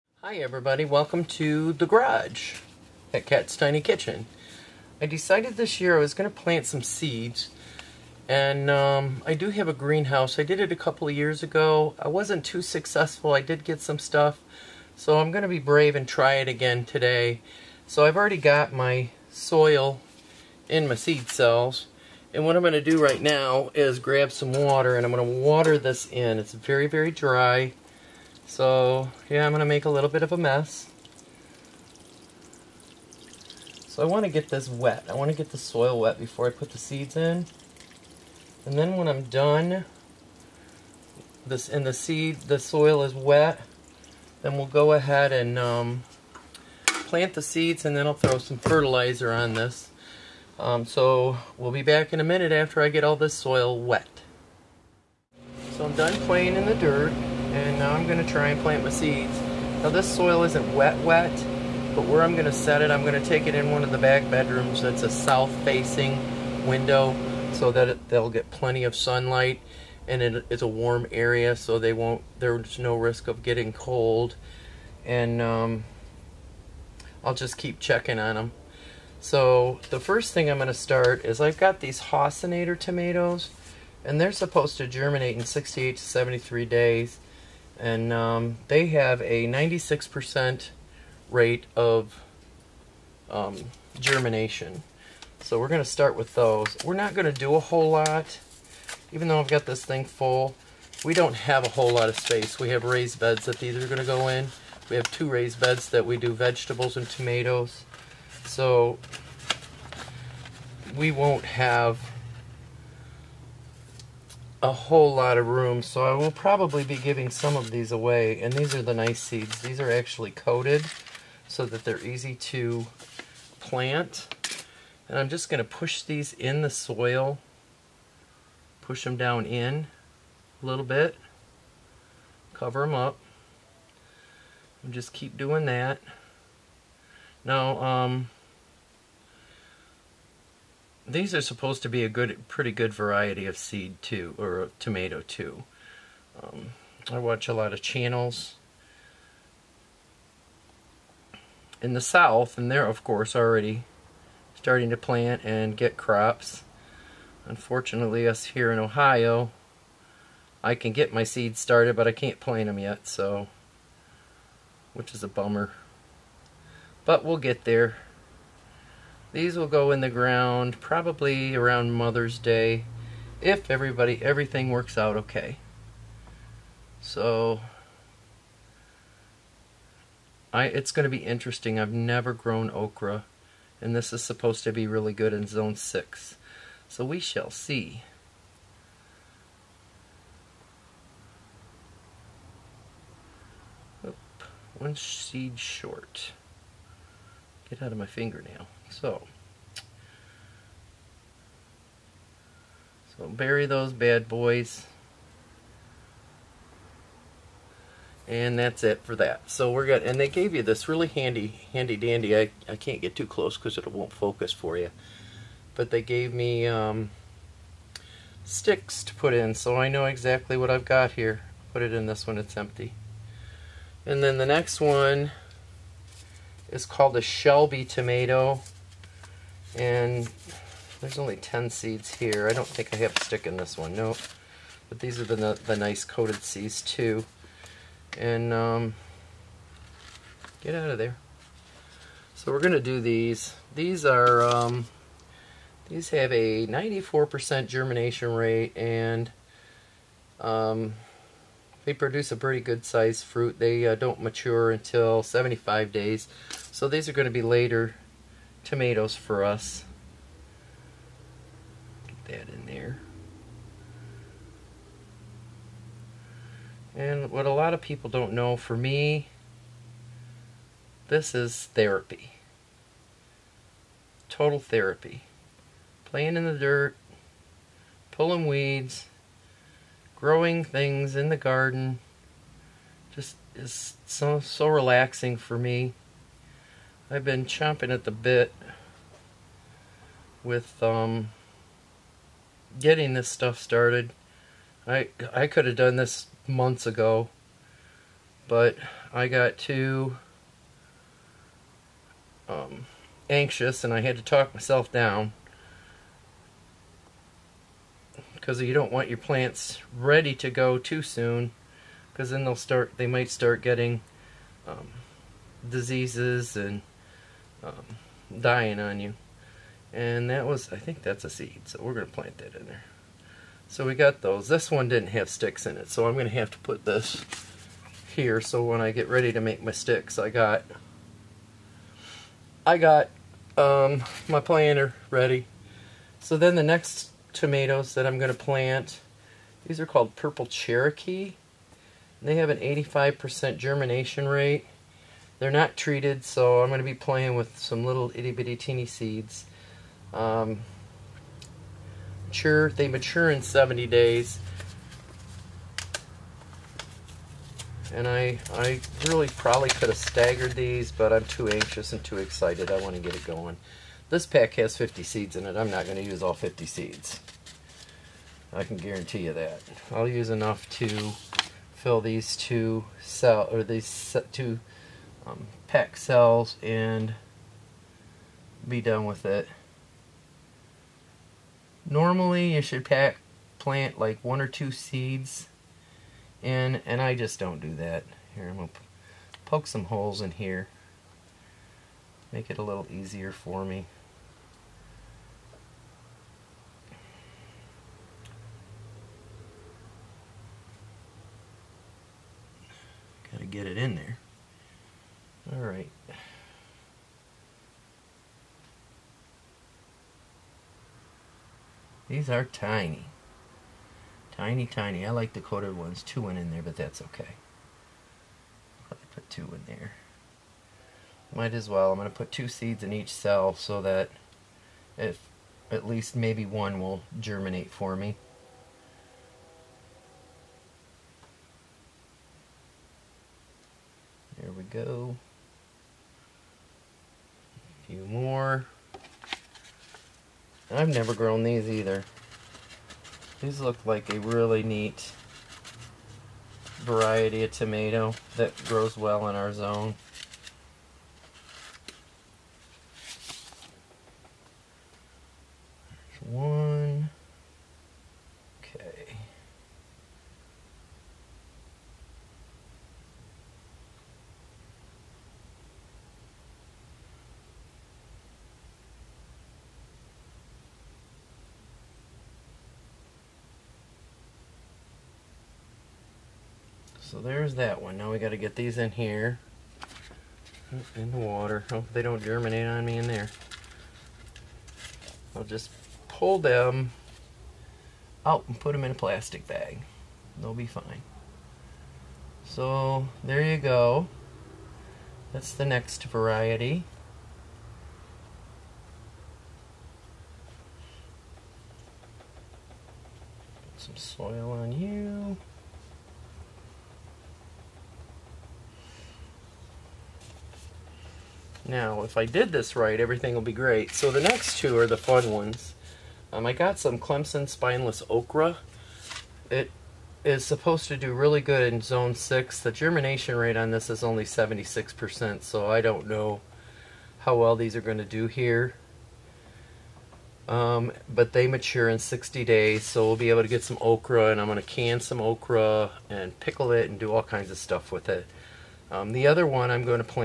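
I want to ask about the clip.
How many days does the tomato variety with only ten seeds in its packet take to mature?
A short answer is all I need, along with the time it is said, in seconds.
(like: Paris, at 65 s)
75 days, at 255 s.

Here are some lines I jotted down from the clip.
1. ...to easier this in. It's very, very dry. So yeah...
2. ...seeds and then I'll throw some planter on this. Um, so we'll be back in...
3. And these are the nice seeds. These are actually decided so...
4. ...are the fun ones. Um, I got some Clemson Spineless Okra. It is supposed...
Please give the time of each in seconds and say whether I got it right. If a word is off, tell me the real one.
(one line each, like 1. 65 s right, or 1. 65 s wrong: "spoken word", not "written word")
1. 25 s wrong: "water", not "easier"
2. 47 s wrong: "fertilizer", not "planter"
3. 118 s wrong: "coated", not "decided"
4. 514 s right.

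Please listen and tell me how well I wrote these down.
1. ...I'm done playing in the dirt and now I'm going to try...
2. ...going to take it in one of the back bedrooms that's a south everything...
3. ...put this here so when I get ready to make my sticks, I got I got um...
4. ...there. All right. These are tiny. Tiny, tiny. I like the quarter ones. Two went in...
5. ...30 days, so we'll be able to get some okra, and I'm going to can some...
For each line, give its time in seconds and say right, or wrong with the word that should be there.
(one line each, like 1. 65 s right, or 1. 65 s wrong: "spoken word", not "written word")
1. 55 s right
2. 63 s wrong: "facing", not "everything"
3. 326 s right
4. 403 s right
5. 531 s wrong: "60", not "30".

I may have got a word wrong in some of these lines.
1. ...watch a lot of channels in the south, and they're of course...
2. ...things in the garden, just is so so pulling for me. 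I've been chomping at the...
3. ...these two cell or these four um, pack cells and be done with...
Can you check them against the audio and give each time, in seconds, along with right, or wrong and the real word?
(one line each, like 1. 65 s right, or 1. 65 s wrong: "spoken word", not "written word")
1. 147 s right
2. 280 s wrong: "relaxing", not "pulling"
3. 371 s wrong: "two", not "four".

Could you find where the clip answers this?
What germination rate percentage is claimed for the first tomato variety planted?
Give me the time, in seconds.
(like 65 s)
89 s.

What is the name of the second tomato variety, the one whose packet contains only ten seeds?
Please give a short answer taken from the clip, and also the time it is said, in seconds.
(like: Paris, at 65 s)
Shelby, at 227 s.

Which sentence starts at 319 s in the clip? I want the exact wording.
And that was, I think that's a seed, so we're going to plant that in there.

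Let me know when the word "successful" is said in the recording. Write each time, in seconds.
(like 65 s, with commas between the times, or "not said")
12 s.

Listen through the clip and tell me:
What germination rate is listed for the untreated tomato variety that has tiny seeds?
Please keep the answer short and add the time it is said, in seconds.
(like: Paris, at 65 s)
85%, at 342 s.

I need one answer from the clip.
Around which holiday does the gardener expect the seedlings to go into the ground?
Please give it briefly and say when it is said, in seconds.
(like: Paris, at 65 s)
Mother's Day, at 171 s.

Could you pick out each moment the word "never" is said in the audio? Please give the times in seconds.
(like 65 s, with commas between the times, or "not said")
181 s, 440 s.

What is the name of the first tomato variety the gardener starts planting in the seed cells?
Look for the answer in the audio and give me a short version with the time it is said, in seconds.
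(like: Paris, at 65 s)
Haussinator, at 82 s.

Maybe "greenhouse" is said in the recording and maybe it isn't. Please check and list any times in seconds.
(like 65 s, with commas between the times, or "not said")
9 s.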